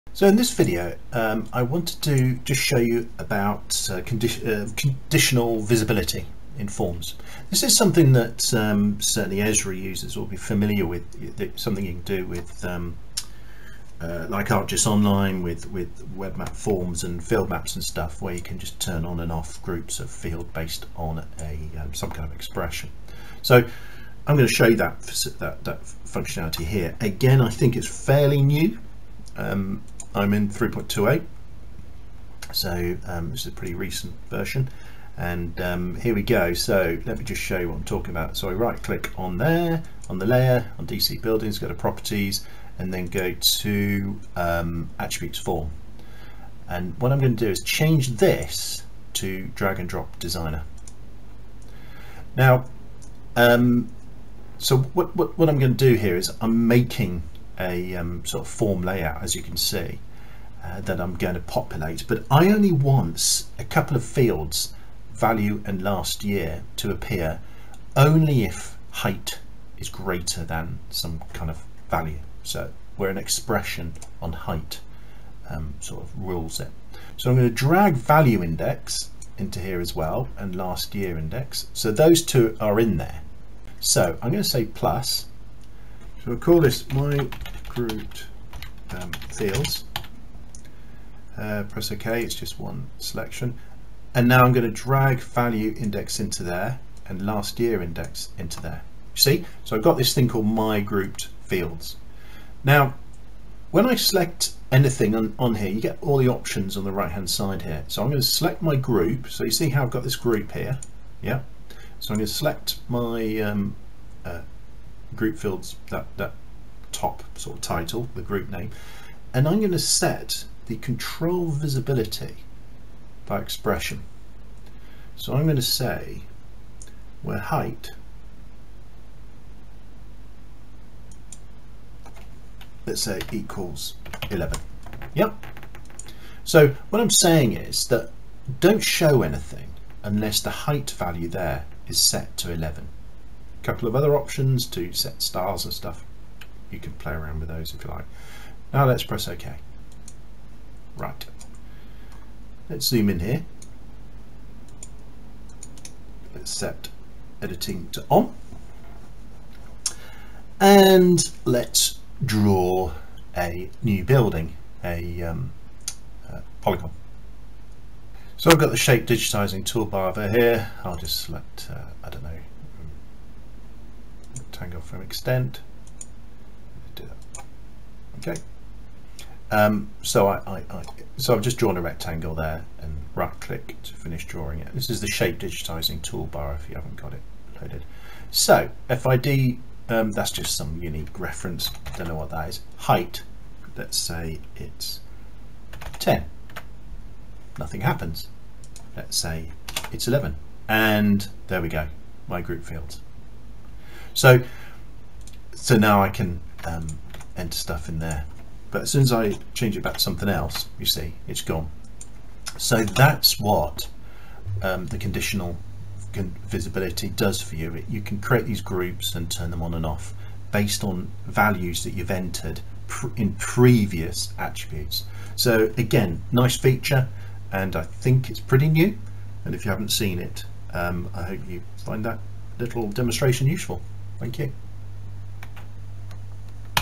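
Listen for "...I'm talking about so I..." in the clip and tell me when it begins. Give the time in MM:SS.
00:37.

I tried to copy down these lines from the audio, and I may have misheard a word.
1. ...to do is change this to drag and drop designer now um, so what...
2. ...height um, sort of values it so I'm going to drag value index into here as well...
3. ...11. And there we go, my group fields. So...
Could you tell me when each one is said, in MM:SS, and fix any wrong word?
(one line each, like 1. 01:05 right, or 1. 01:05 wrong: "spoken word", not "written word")
1. 00:47 right
2. 01:14 wrong: "rules", not "values"
3. 03:20 right.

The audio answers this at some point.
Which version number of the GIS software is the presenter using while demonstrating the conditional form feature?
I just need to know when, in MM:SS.
00:30.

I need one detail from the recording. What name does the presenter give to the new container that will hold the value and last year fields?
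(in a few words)
my grouped fields.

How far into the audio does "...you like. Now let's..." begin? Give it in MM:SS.
02:27.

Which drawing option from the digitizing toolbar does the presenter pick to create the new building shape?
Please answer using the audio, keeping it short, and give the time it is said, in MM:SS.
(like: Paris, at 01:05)
rectangle from extent, at 02:54.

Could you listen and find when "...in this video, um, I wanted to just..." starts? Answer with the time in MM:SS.
00:00.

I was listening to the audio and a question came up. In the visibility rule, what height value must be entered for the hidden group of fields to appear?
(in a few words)
11.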